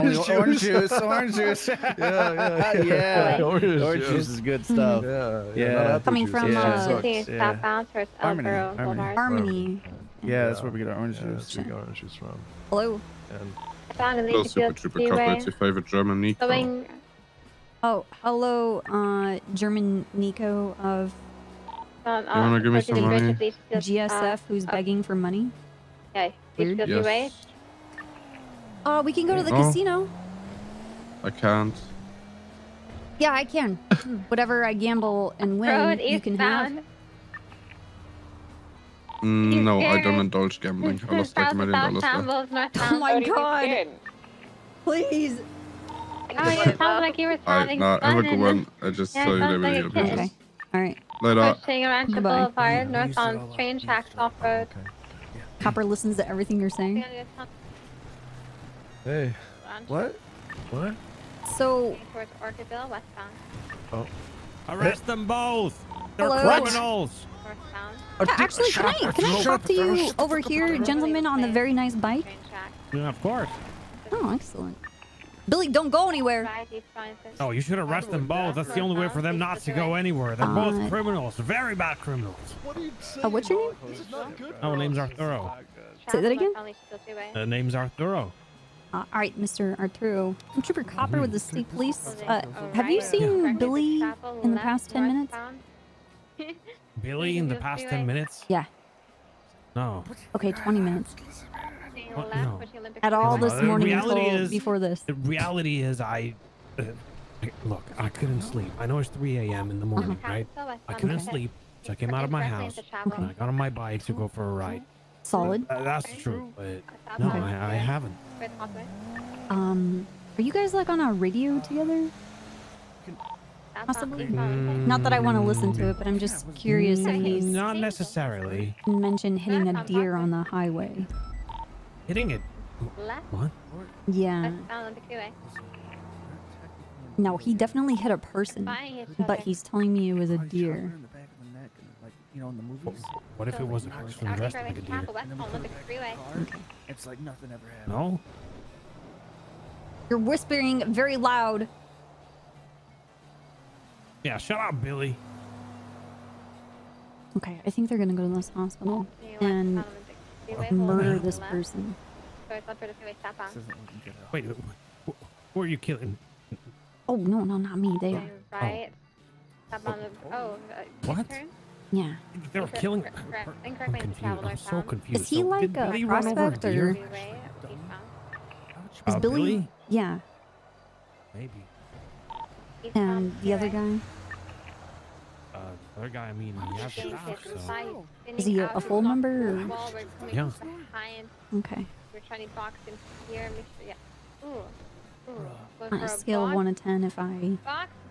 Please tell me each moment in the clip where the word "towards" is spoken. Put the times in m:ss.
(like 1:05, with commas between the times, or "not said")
0:07, 1:02.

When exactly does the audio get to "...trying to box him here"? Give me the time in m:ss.
3:12.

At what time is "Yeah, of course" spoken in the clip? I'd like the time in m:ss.
1:12.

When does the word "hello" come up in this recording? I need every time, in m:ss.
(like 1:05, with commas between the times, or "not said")
0:12, 0:18.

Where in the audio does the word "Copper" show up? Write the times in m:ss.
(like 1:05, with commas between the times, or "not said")
0:55, 1:30.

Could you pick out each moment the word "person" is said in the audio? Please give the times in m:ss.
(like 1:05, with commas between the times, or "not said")
2:18, 2:41.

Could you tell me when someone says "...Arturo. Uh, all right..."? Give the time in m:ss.
1:27.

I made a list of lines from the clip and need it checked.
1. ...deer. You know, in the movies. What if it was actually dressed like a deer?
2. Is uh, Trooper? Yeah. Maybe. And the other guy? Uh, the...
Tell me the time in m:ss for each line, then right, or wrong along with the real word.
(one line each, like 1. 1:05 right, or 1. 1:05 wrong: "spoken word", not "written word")
1. 2:20 right
2. 2:59 wrong: "Billy", not "Trooper".